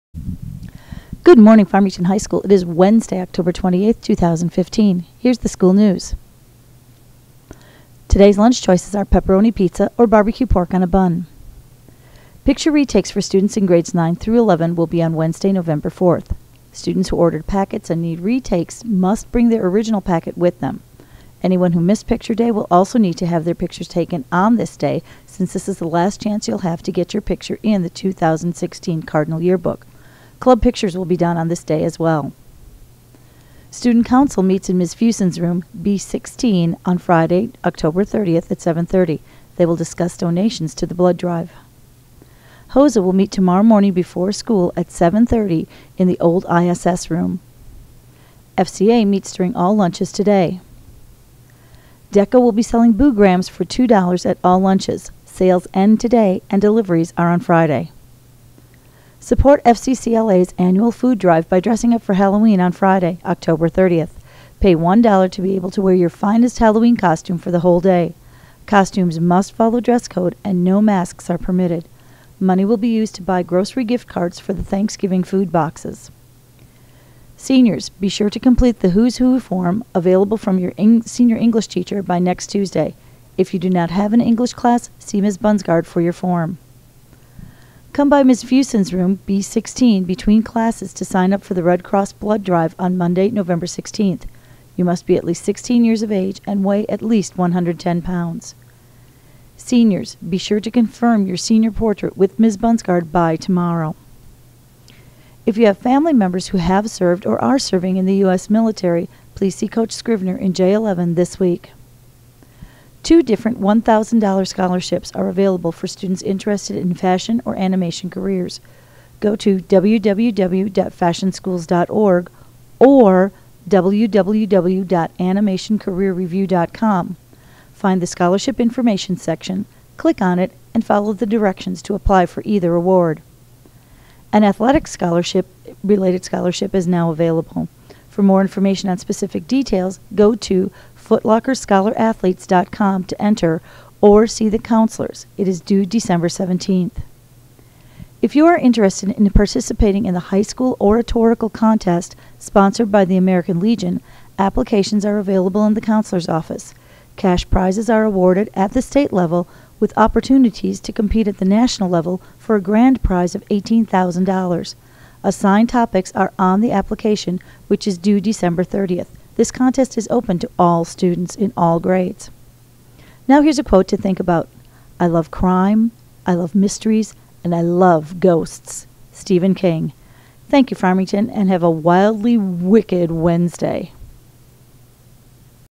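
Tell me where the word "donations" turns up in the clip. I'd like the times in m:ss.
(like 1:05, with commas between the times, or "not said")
0:40.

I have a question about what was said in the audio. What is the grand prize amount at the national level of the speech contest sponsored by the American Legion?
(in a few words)
$18,000.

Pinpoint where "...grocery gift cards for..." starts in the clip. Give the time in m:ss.
1:13.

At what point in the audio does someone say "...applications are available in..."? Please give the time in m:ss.
2:34.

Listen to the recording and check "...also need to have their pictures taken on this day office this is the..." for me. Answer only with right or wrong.
wrong.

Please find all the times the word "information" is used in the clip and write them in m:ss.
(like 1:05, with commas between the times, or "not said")
2:08, 2:18.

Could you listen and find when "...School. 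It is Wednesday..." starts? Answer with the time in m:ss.
0:02.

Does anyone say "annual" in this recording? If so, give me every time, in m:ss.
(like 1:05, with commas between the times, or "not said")
1:00.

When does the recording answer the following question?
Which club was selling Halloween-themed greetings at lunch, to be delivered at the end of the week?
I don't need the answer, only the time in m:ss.
0:52.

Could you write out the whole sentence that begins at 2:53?
Now here's a quote to think about.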